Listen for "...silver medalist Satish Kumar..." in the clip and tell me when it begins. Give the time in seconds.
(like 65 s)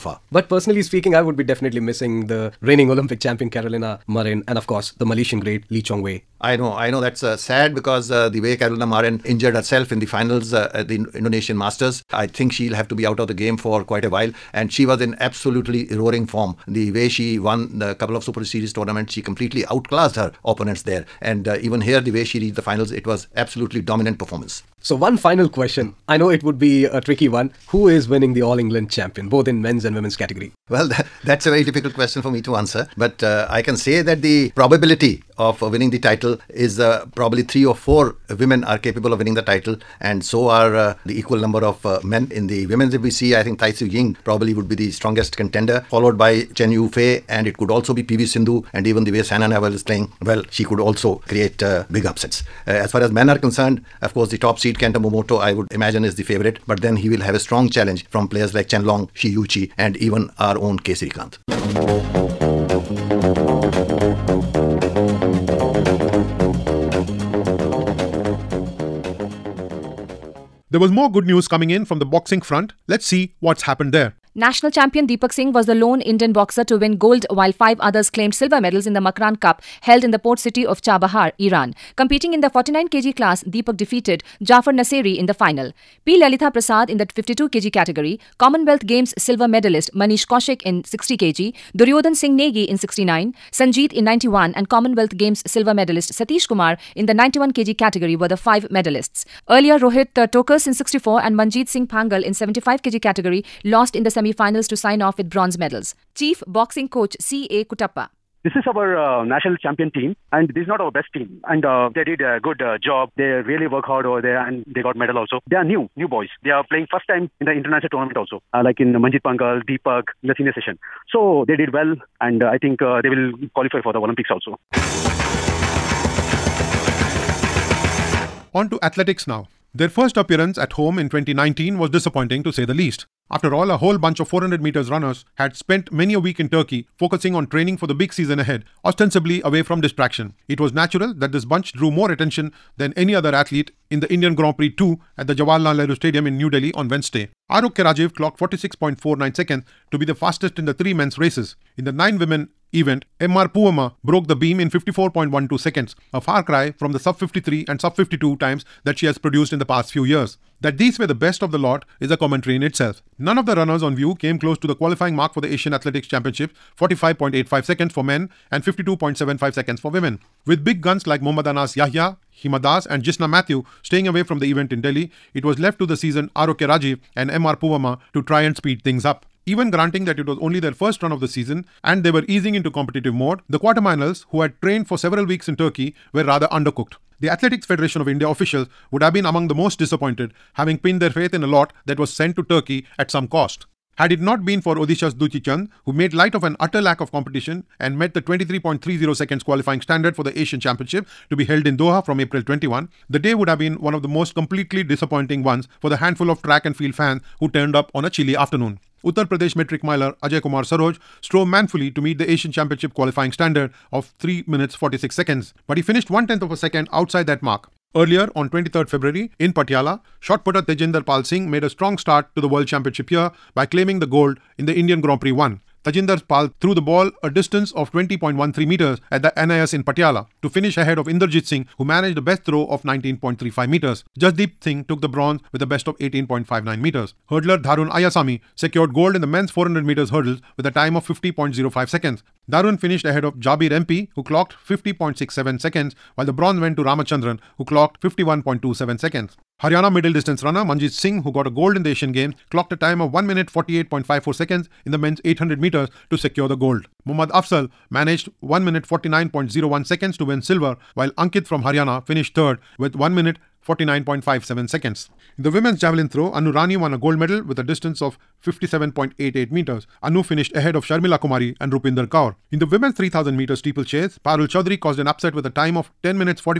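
95 s.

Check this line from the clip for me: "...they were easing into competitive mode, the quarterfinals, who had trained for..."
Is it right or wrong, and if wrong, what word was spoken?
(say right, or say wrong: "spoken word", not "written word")
right.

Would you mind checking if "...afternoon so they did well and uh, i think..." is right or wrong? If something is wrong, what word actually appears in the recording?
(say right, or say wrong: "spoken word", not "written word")
wrong: "session", not "afternoon".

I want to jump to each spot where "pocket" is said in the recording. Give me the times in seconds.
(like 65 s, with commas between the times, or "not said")
not said.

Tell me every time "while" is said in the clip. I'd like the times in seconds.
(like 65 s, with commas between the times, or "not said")
14 s, 77 s, 246 s, 260 s.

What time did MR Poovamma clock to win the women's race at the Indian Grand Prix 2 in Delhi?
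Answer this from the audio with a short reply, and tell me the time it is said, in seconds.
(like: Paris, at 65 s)
54.12 seconds, at 154 s.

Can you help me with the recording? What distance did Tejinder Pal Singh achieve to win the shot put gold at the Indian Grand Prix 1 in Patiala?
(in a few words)
20.13 meters.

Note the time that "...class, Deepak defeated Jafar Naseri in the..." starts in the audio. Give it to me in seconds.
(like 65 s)
83 s.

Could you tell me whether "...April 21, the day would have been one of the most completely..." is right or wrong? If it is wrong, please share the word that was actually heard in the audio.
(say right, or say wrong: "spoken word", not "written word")
right.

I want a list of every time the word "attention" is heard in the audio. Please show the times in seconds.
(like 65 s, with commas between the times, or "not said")
142 s.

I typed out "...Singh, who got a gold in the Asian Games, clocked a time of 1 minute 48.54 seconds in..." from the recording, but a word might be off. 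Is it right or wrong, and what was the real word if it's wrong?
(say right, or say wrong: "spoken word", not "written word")
right.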